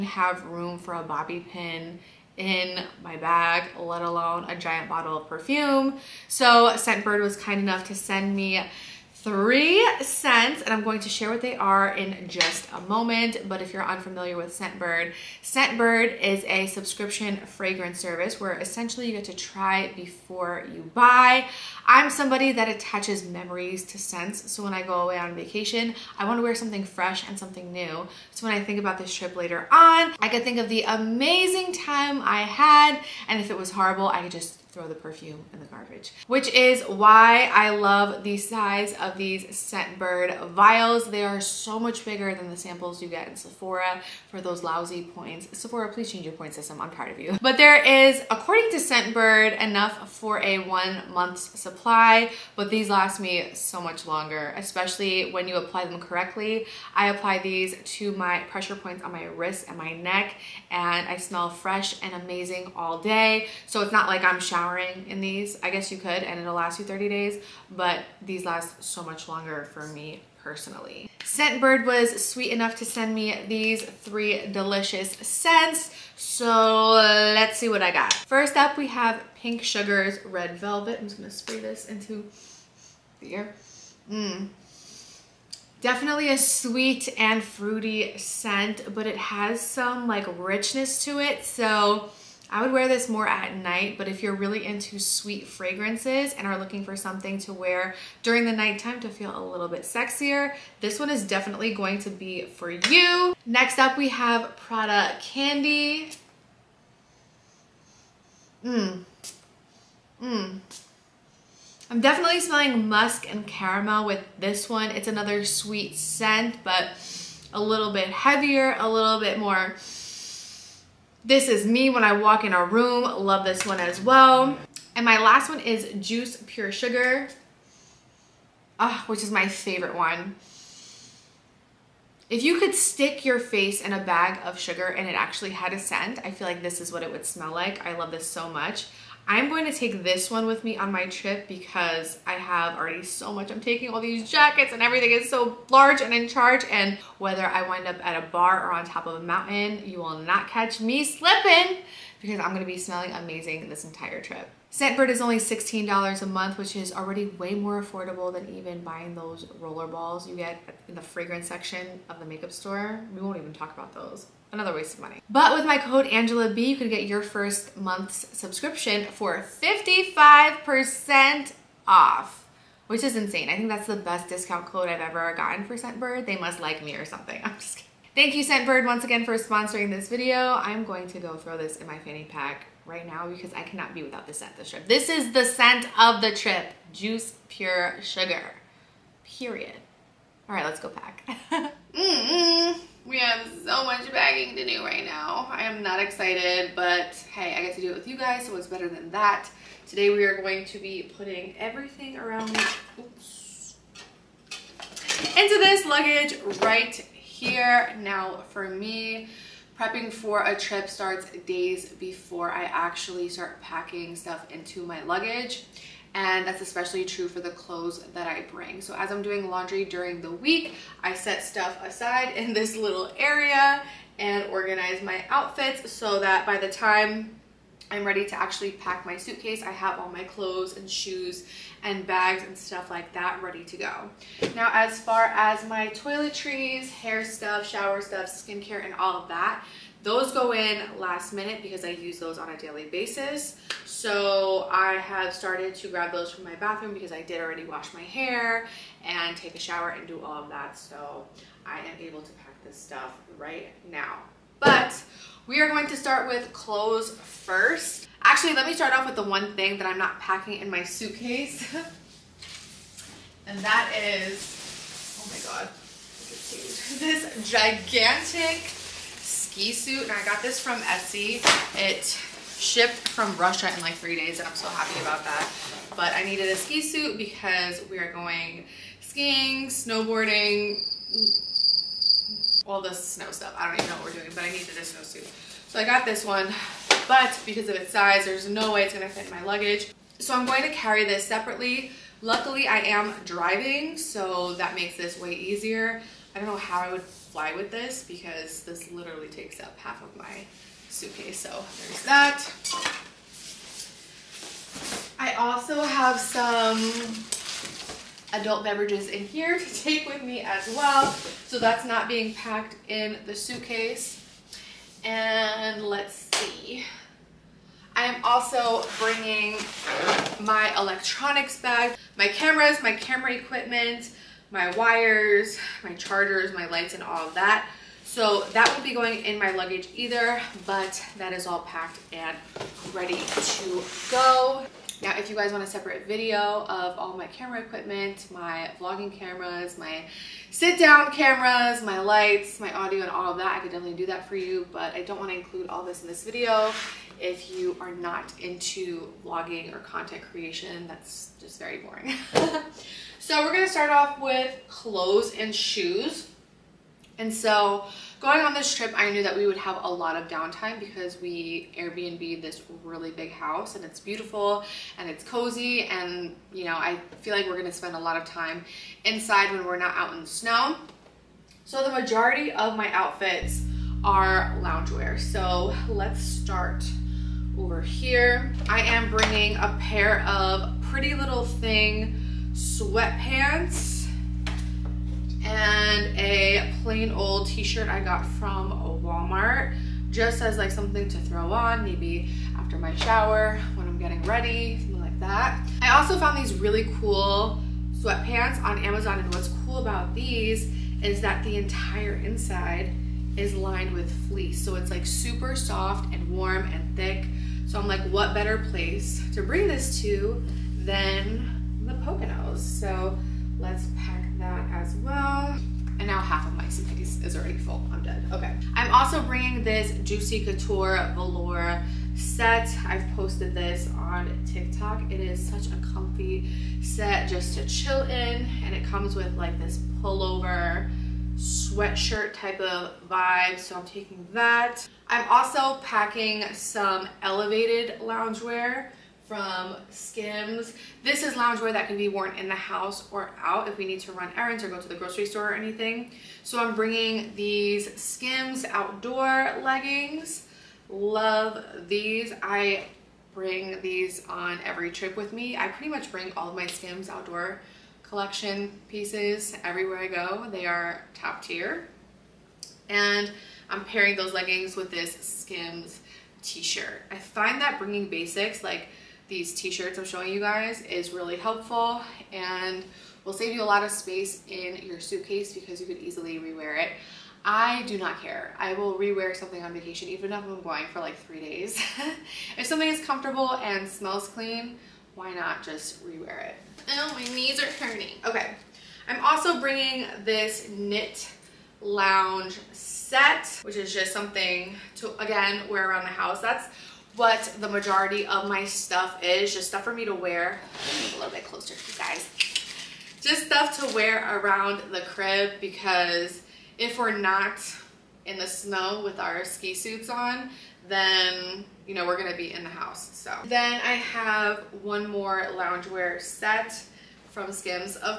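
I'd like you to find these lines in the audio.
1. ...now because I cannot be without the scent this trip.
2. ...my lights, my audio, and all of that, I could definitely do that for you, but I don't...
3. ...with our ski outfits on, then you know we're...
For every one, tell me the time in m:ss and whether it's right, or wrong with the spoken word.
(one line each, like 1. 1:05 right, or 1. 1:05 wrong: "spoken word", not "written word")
1. 3:03 right
2. 5:41 right
3. 8:29 wrong: "suits", not "outfits".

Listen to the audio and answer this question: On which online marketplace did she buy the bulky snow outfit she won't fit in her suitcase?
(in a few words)
Etsy.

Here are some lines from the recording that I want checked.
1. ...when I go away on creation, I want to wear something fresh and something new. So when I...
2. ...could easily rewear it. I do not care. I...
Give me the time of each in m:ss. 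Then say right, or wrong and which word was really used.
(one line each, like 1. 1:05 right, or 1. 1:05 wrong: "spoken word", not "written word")
1. 0:24 wrong: "vacation", not "creation"
2. 7:55 right.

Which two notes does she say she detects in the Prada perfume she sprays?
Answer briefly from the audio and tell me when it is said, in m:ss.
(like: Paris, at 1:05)
musk and caramel, at 1:52.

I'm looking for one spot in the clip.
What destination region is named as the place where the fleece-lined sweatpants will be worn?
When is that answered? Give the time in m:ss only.
6:51.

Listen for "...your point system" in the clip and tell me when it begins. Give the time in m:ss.
0:46.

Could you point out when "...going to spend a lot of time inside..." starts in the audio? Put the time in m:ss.
6:07.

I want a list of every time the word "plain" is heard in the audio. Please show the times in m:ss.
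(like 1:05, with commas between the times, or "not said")
6:26.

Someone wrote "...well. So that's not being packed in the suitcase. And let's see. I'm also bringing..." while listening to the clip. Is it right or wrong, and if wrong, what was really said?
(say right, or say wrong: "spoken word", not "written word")
right.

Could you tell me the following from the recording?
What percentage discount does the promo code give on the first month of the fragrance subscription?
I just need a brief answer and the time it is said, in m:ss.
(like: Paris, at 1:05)
55%, at 2:49.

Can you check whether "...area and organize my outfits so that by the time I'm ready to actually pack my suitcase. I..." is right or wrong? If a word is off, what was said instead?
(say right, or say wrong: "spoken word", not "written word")
right.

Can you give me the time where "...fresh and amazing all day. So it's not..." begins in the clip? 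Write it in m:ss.
1:01.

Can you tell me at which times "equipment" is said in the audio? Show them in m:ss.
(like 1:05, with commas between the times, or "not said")
5:23, 5:37.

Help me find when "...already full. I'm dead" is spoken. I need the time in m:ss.
6:57.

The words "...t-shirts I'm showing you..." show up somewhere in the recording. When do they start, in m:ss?
7:49.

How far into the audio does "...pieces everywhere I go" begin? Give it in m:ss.
7:38.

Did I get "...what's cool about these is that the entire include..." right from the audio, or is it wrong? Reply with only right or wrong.
wrong.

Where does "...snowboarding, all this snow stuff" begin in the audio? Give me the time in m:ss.
4:39.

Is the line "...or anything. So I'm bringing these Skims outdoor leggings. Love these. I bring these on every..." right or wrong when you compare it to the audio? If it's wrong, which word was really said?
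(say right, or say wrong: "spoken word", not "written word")
right.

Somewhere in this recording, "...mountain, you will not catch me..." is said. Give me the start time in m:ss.
2:29.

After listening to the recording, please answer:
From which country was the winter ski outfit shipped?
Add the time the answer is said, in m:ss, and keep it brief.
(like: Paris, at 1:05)
Russia, at 4:33.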